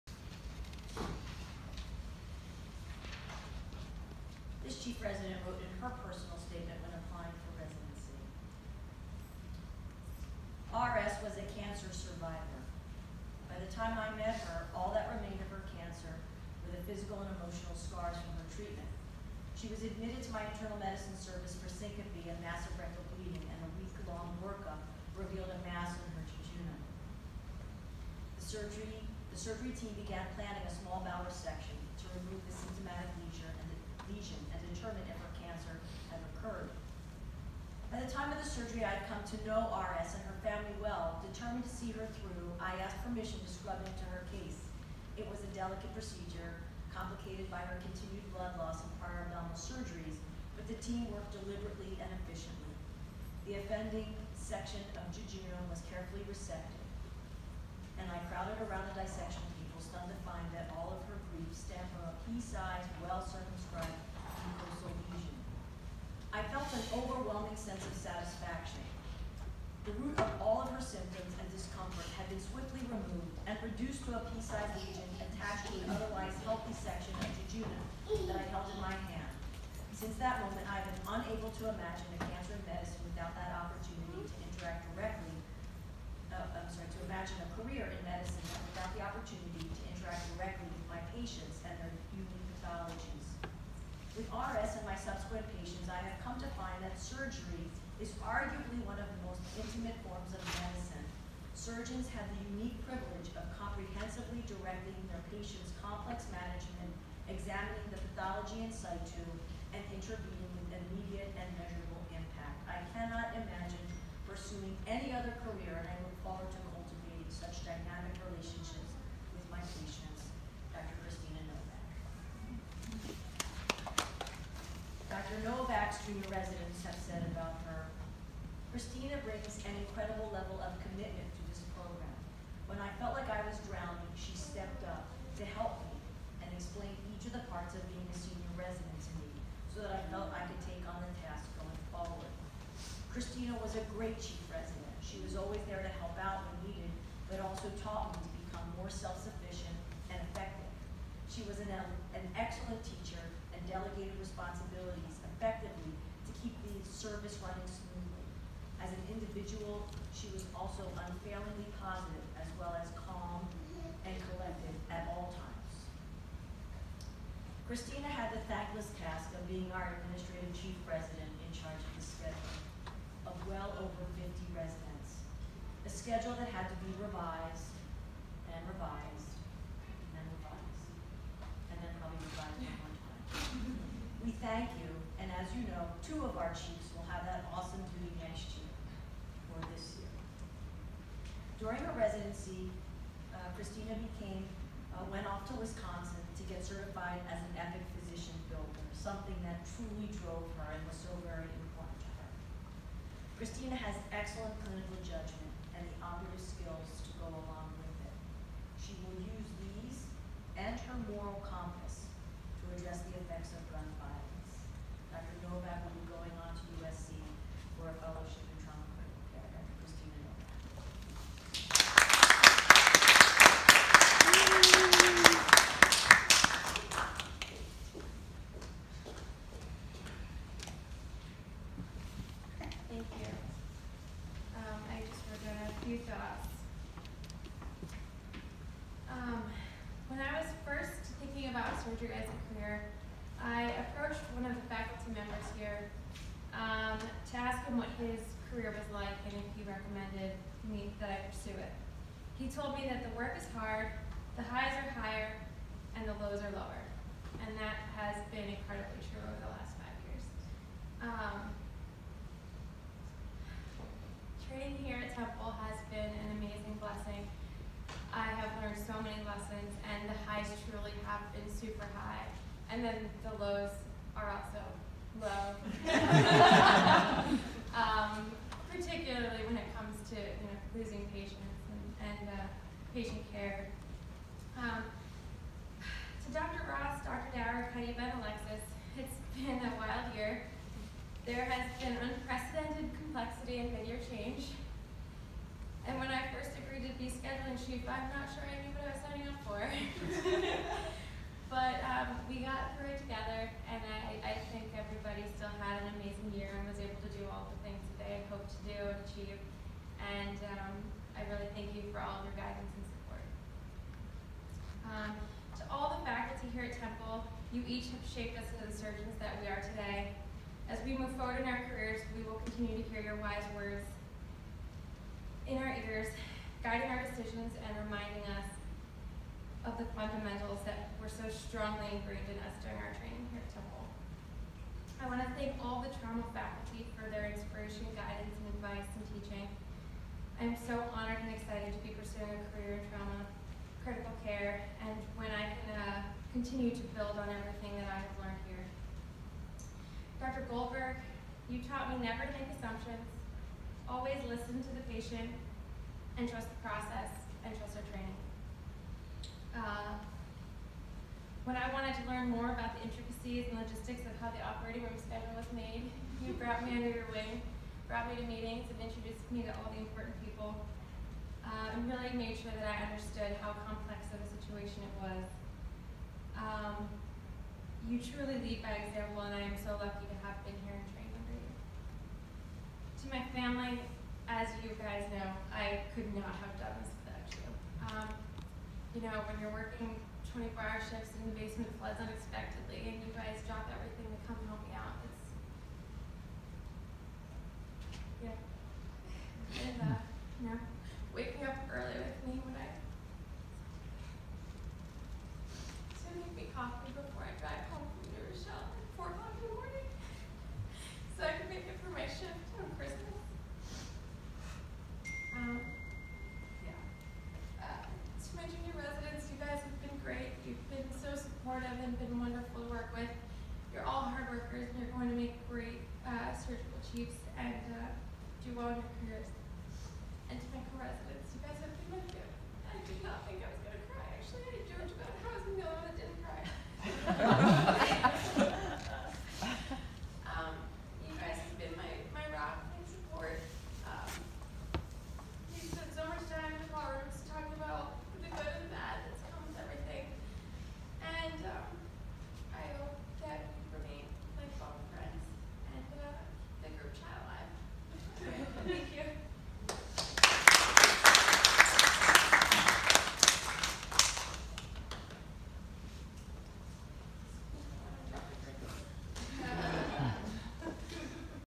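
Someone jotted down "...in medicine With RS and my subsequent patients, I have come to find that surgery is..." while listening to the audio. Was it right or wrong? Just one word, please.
right.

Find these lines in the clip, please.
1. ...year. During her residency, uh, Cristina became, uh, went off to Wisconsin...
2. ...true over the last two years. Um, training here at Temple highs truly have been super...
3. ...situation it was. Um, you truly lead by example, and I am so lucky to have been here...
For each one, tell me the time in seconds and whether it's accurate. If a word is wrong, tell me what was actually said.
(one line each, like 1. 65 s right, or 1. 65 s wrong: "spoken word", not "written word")
1. 190 s right
2. 259 s wrong: "five", not "two"
3. 374 s right.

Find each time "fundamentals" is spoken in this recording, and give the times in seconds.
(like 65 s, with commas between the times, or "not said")
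329 s.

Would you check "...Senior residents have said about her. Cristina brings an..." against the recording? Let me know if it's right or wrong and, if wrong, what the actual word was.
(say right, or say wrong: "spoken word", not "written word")
right.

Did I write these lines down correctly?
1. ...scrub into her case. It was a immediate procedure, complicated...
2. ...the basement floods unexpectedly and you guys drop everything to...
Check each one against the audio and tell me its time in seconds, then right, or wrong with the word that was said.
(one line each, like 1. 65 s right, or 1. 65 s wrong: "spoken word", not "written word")
1. 43 s wrong: "delicate", not "immediate"
2. 391 s right.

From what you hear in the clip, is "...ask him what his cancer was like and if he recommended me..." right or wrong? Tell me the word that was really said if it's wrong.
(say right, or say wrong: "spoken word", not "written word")
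wrong: "career", not "cancer".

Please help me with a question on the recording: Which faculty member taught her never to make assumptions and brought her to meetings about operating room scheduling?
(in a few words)
Dr. Goldberg.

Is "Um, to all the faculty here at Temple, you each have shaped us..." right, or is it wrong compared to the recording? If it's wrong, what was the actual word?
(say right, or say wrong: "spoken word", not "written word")
right.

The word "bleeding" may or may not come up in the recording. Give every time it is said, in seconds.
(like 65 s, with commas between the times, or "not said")
23 s.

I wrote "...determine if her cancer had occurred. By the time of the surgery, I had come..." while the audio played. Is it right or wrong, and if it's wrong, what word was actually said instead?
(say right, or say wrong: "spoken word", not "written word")
right.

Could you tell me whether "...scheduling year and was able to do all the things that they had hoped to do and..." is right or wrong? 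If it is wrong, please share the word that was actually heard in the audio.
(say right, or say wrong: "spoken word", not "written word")
wrong: "amazing", not "scheduling".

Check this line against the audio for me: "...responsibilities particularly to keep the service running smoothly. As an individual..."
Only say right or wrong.
wrong.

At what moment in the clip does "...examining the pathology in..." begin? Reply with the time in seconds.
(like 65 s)
107 s.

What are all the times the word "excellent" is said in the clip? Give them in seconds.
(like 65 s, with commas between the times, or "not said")
152 s, 204 s.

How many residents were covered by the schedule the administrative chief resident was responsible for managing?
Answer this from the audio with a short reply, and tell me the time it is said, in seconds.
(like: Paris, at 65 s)
Over 50, at 173 s.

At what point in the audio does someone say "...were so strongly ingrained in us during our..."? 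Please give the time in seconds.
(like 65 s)
331 s.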